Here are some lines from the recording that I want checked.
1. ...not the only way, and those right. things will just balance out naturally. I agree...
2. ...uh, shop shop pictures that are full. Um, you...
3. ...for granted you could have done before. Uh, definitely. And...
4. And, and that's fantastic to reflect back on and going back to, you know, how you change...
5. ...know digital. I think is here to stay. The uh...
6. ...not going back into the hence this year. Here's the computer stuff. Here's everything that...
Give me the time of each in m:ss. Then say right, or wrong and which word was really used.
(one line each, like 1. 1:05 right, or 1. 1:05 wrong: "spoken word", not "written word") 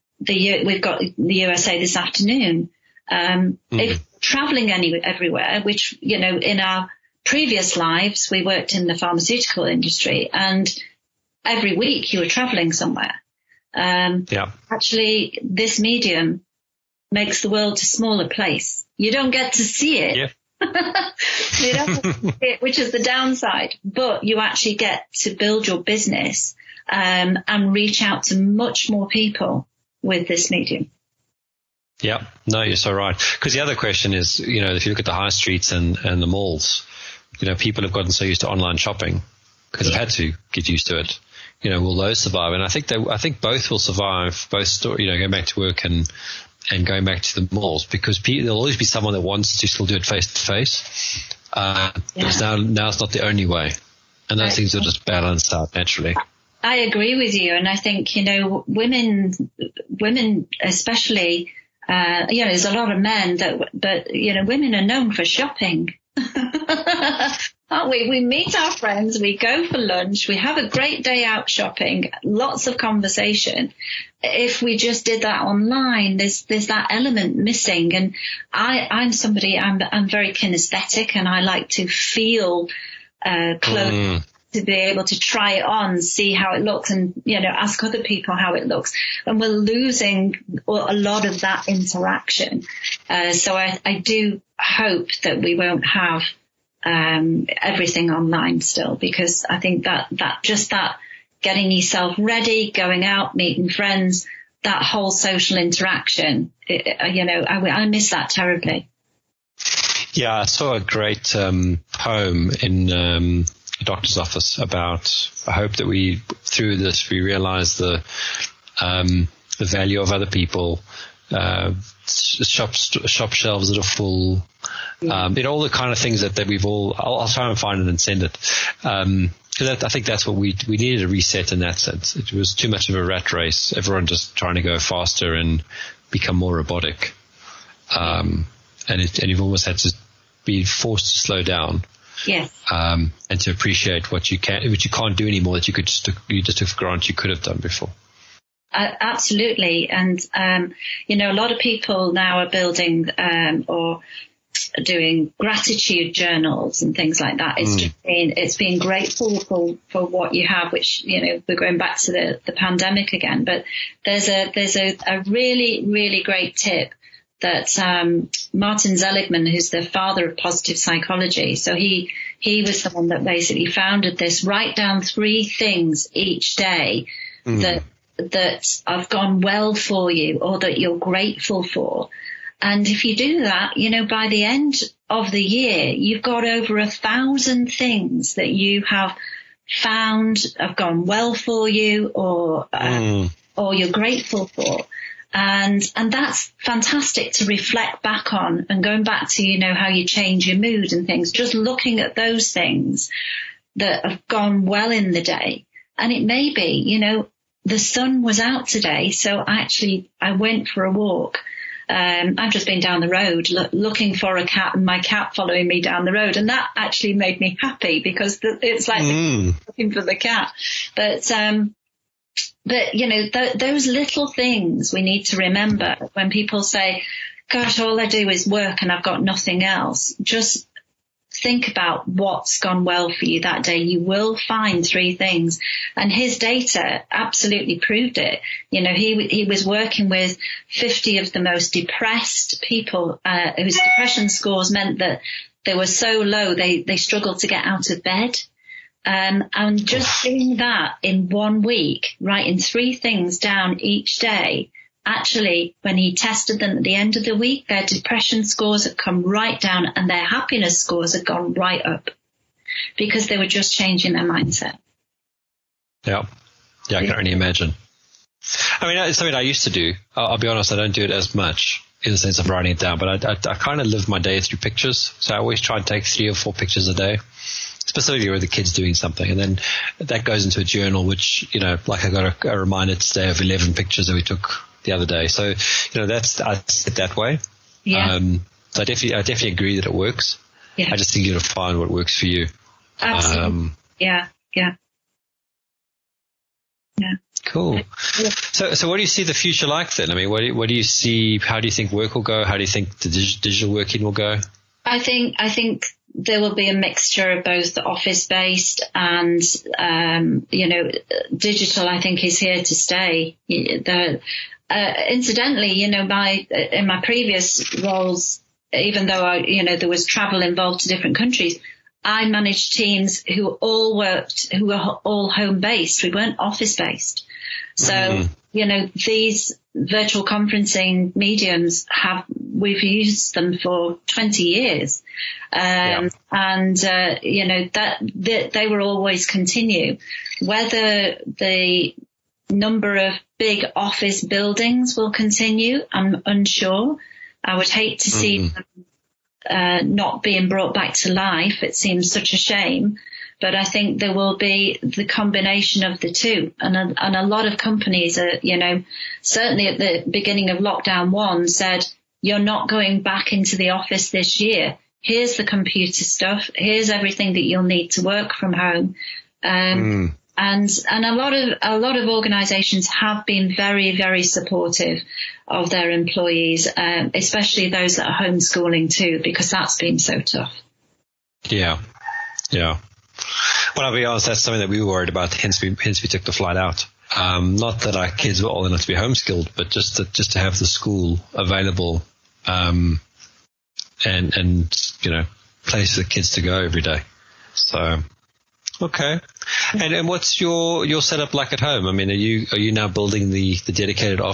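1. 0:53 right
2. 2:01 wrong: "shelves", not "pictures"
3. 2:26 wrong: "absolutely", not "definitely"
4. 3:15 right
5. 5:10 right
6. 6:02 wrong: "office", not "hence".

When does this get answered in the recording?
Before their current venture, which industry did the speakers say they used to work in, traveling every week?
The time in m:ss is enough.
0:08.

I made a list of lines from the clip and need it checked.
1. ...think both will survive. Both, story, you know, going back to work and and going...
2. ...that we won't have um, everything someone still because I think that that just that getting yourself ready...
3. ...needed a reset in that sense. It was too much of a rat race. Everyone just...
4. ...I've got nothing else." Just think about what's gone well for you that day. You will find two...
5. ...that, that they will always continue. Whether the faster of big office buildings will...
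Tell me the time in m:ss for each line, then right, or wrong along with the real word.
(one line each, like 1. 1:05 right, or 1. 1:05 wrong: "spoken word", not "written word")
1. 0:43 right
2. 1:35 wrong: "online", not "someone"
3. 2:10 right
4. 3:48 wrong: "three", not "two"
5. 5:37 wrong: "number", not "faster".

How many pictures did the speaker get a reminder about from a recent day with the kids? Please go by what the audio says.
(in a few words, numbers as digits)
11.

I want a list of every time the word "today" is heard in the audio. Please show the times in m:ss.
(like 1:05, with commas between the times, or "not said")
3:28, 4:42.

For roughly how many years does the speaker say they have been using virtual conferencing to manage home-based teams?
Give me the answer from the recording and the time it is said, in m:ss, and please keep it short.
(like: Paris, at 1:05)
20 years, at 5:34.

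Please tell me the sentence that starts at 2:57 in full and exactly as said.
that that I've gone well for you or that you're grateful for.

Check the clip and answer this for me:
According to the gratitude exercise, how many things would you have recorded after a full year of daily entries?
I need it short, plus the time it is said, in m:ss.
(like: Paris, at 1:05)
over a thousand, at 3:06.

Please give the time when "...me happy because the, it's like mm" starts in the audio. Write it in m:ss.
3:37.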